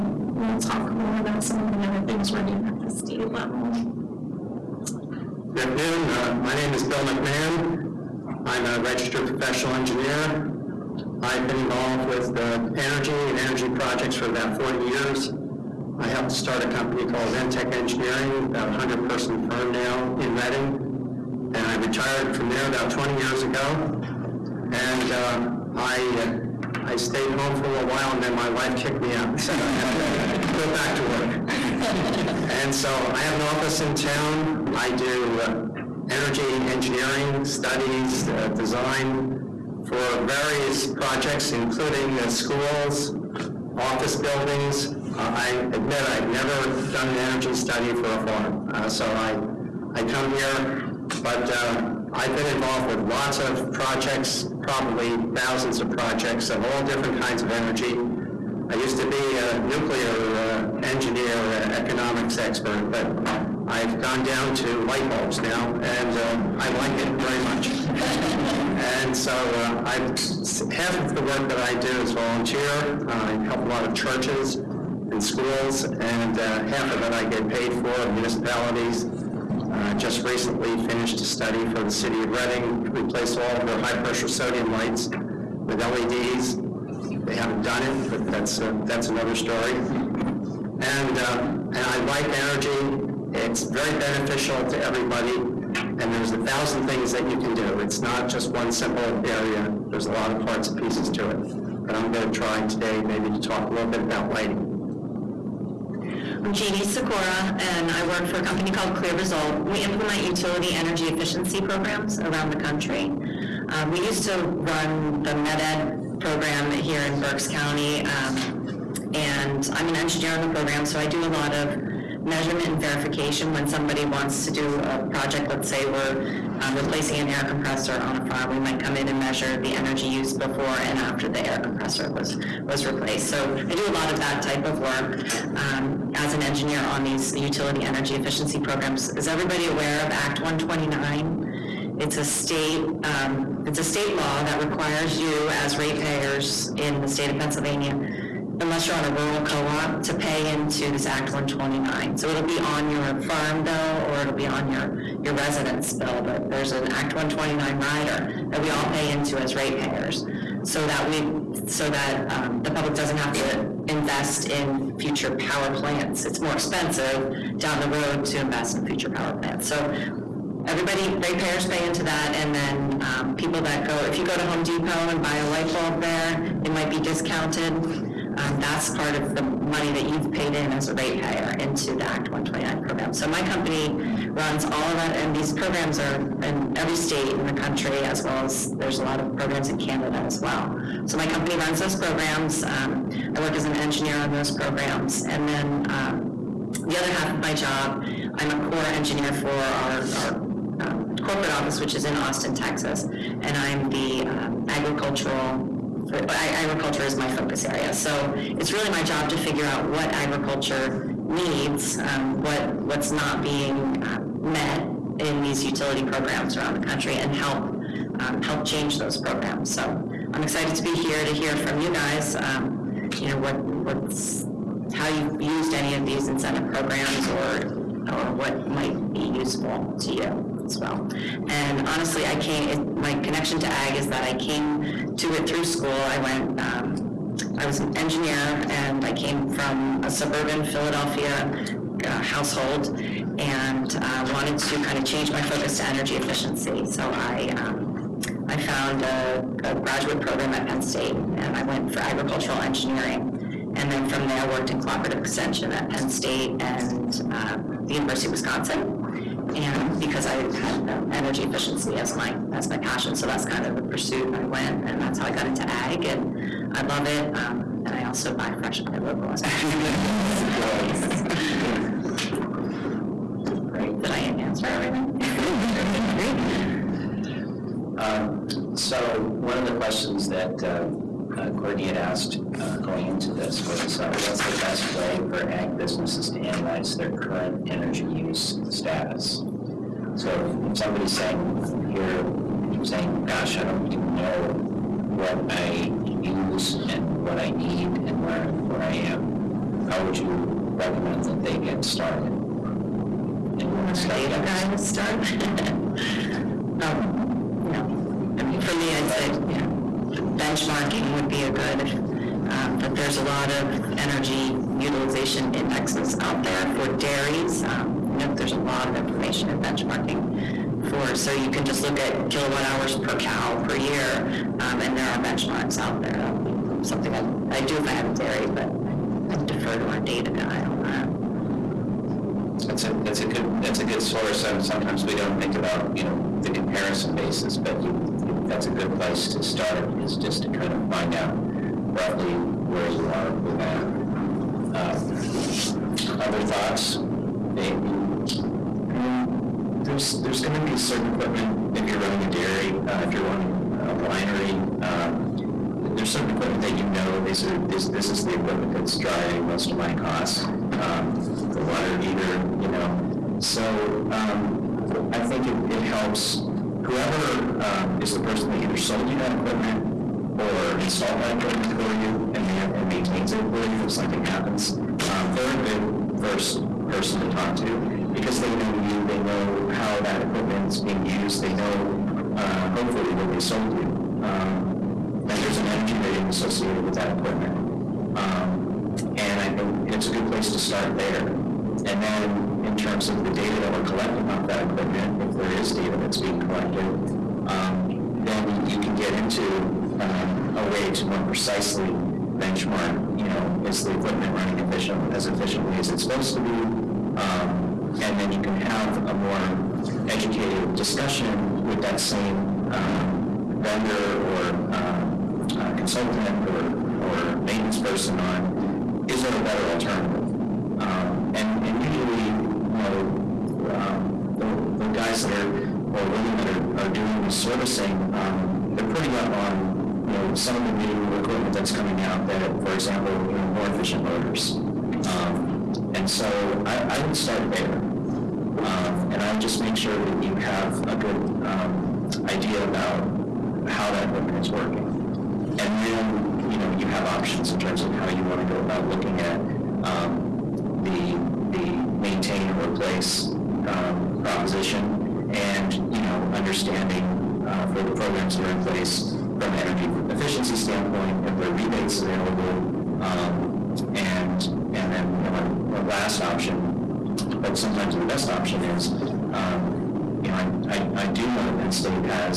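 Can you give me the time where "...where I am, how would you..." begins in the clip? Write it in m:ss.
4:58.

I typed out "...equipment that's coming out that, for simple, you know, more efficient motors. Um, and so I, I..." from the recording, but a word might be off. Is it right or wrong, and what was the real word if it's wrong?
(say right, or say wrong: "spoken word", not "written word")
wrong: "example", not "simple".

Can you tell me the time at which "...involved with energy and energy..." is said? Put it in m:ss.
0:11.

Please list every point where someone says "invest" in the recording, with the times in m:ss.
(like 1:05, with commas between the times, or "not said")
2:43, 2:48.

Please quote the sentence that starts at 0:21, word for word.
And I retired from there about 20 years ago.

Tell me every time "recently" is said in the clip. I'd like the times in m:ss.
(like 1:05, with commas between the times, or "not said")
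1:20.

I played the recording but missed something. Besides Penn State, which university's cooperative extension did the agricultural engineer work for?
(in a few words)
University of Wisconsin.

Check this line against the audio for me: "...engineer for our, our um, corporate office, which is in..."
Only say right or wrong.
right.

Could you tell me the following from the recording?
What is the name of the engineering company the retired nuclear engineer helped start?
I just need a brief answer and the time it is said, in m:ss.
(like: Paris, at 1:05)
Ventech Engineering, at 0:17.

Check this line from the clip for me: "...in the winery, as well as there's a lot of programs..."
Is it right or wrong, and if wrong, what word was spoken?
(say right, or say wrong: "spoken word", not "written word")
wrong: "country", not "winery".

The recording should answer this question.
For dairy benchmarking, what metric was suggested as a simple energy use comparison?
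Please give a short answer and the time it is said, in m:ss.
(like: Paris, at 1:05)
kilowatt hours per cow per year, at 5:22.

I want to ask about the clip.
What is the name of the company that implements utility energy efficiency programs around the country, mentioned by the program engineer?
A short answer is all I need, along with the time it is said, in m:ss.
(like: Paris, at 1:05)
Clear Result, at 1:48.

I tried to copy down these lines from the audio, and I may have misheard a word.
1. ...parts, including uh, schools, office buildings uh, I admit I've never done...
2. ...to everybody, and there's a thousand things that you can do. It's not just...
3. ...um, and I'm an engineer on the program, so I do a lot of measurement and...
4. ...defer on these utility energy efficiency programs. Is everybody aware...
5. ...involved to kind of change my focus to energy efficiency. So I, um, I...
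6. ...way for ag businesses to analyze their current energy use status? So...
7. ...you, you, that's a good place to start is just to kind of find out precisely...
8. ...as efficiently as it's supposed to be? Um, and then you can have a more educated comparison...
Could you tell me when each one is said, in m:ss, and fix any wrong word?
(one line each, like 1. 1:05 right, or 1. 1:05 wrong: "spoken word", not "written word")
1. 0:40 wrong: "projects", not "parts"
2. 1:34 right
3. 1:58 right
4. 2:16 wrong: "engineer", not "defer"
5. 4:04 wrong: "wanted", not "involved"
6. 4:44 right
7. 5:37 wrong: "roughly", not "precisely"
8. 6:45 wrong: "discussion", not "comparison".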